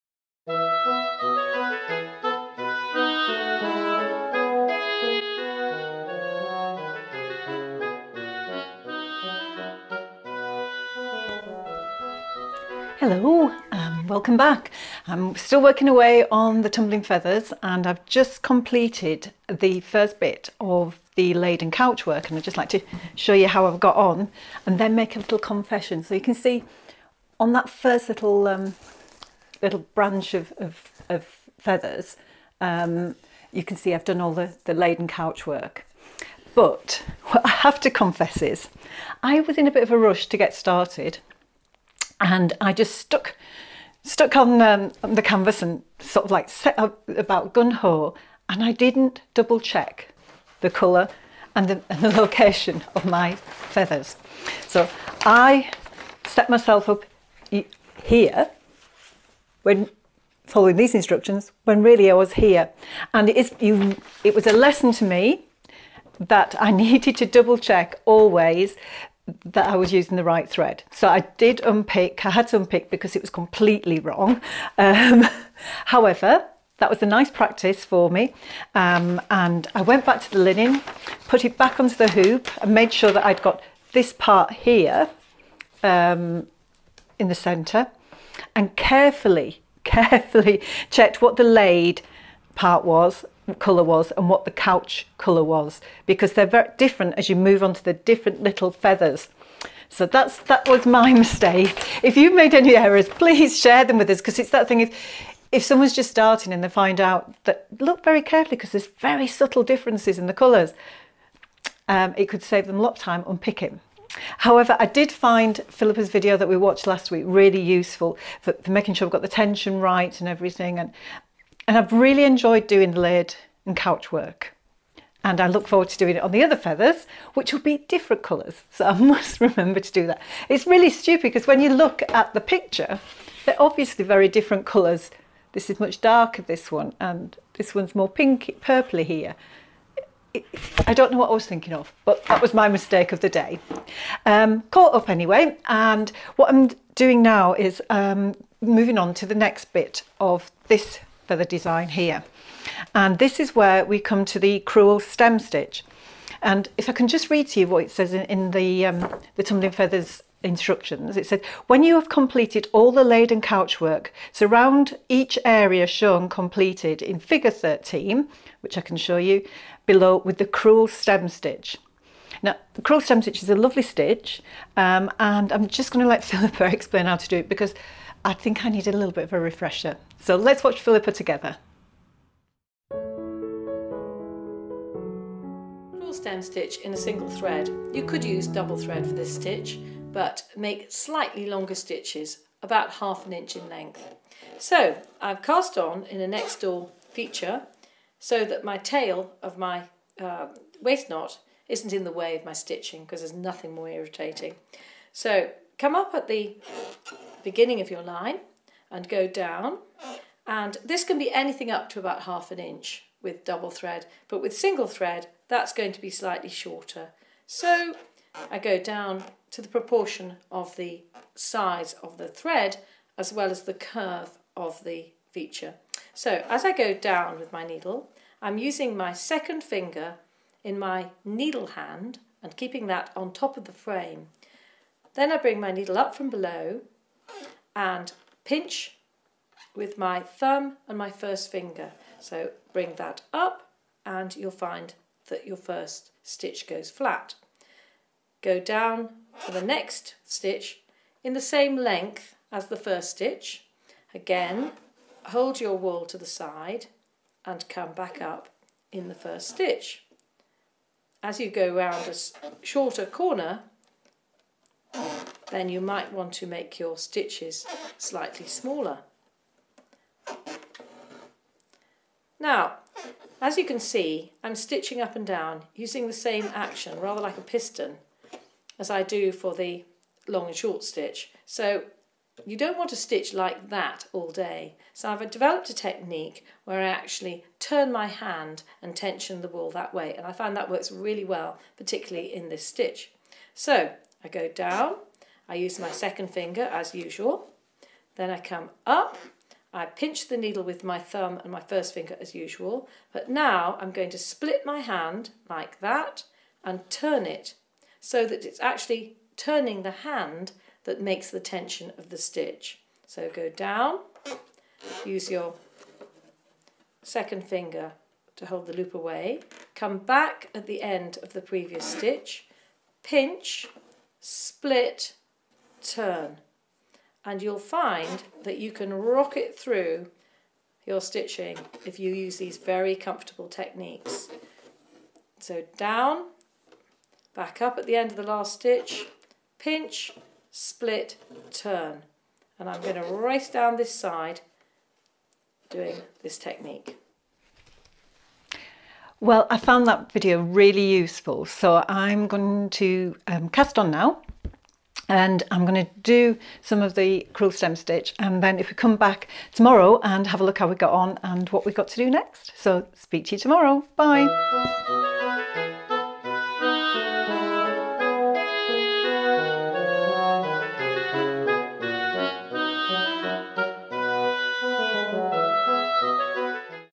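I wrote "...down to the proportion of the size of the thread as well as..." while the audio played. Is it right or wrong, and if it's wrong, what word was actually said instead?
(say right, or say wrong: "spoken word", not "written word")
right.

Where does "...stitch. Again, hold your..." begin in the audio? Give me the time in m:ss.
4:13.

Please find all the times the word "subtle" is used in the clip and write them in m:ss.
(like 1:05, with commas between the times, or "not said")
1:49.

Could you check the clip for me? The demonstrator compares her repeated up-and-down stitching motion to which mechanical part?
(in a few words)
a piston.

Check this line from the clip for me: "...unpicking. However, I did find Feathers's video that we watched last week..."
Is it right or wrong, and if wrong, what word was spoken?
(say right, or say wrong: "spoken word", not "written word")
wrong: "Phillipa", not "Feathers".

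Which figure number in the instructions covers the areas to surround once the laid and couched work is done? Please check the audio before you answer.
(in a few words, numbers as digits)
13.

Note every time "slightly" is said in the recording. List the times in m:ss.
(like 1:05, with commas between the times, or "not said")
3:10, 3:36, 4:27.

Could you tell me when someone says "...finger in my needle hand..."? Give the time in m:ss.
3:49.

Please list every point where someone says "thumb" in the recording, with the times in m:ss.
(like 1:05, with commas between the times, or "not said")
4:00, 5:00.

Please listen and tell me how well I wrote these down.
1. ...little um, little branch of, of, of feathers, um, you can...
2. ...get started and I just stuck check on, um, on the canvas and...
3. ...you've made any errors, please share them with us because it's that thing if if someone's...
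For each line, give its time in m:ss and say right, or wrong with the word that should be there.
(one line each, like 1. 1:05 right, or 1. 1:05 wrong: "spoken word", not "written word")
1. 0:28 right
2. 0:40 wrong: "stuck", not "check"
3. 1:42 right.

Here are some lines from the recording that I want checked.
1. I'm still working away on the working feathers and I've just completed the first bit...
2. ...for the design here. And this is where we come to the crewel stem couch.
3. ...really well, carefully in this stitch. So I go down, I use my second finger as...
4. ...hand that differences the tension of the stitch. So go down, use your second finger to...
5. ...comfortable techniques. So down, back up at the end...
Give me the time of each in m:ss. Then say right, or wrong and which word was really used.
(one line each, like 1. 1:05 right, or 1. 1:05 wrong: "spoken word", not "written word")
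1. 0:15 wrong: "tumbling", not "working"
2. 2:31 wrong: "stitch", not "couch"
3. 4:50 wrong: "particularly", not "carefully"
4. 5:09 wrong: "makes", not "differences"
5. 5:32 right.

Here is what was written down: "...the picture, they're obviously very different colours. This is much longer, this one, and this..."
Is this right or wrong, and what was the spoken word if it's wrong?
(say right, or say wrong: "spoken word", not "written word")
wrong: "darker", not "longer".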